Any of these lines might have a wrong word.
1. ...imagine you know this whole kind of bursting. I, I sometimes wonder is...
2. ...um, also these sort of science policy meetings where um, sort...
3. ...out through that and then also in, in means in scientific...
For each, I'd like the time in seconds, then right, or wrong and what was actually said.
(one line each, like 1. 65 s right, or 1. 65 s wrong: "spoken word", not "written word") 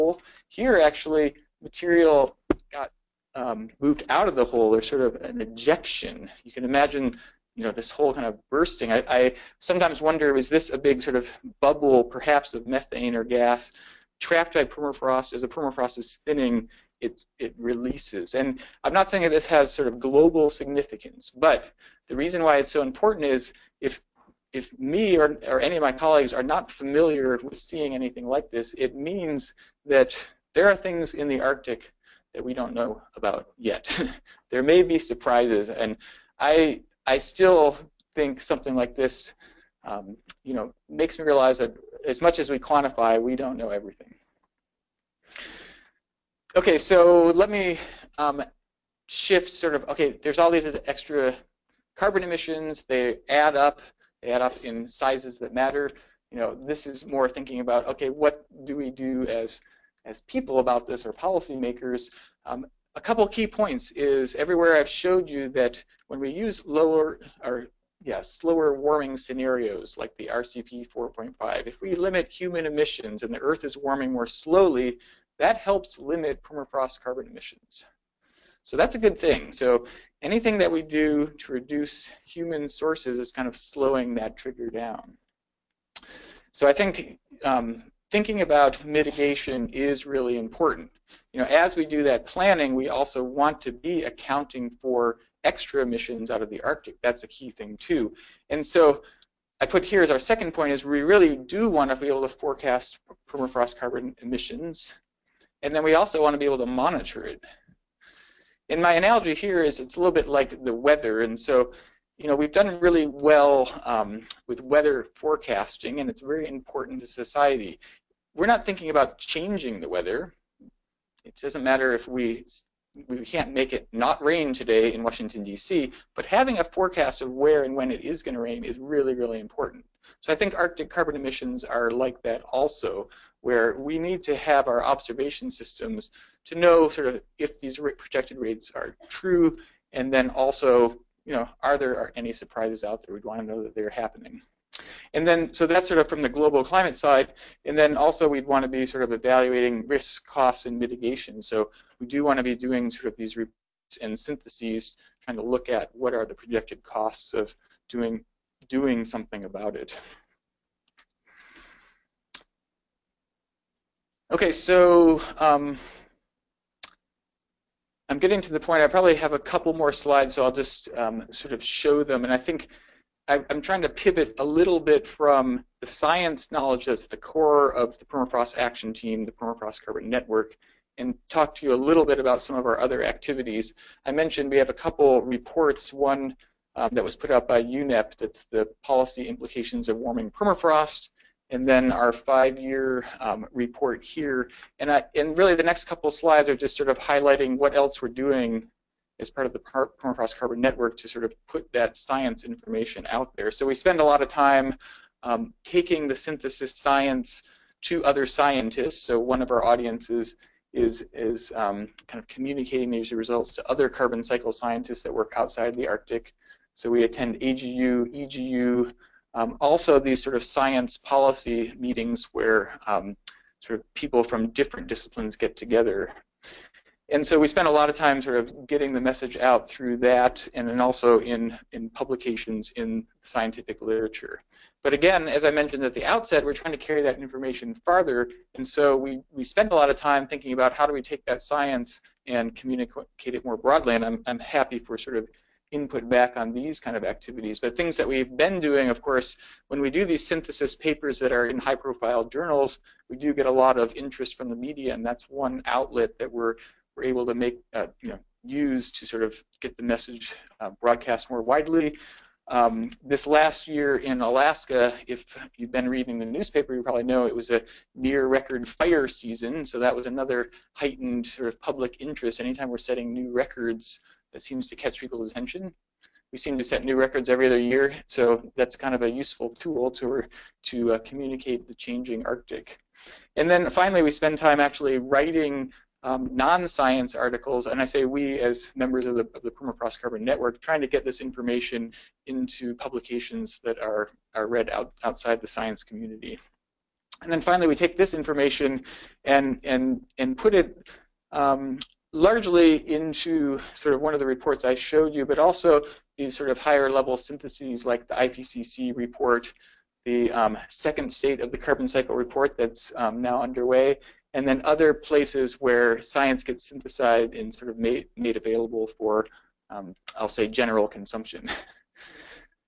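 1. 6 s right
2. 219 s right
3. 229 s wrong: "publications", not "means".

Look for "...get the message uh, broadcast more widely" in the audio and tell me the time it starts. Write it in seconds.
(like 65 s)
259 s.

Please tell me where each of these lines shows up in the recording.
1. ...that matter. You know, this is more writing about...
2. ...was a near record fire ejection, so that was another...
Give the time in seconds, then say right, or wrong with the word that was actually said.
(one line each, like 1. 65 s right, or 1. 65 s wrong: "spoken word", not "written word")
1. 55 s wrong: "thinking", not "writing"
2. 267 s wrong: "season", not "ejection".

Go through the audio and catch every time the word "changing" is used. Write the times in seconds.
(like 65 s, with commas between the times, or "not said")
119 s, 281 s.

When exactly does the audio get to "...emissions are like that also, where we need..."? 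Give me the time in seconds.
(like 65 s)
131 s.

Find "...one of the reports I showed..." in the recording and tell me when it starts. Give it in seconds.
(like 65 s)
304 s.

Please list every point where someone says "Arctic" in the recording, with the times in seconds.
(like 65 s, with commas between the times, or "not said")
31 s, 96 s, 130 s, 215 s, 282 s.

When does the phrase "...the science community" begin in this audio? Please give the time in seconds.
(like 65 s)
295 s.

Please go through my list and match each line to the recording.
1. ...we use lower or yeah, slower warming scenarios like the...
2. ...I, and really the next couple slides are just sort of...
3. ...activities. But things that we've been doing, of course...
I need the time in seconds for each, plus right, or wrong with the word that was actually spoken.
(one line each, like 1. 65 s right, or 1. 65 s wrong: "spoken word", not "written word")
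1. 66 s right
2. 194 s right
3. 247 s right.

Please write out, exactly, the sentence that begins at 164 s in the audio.
Okay, so um, I'm getting to the point.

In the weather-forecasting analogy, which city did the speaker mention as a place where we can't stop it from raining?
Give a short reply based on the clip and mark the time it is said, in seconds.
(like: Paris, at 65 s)
Washington D.C., at 125 s.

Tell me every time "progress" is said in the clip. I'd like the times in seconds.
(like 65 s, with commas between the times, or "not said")
not said.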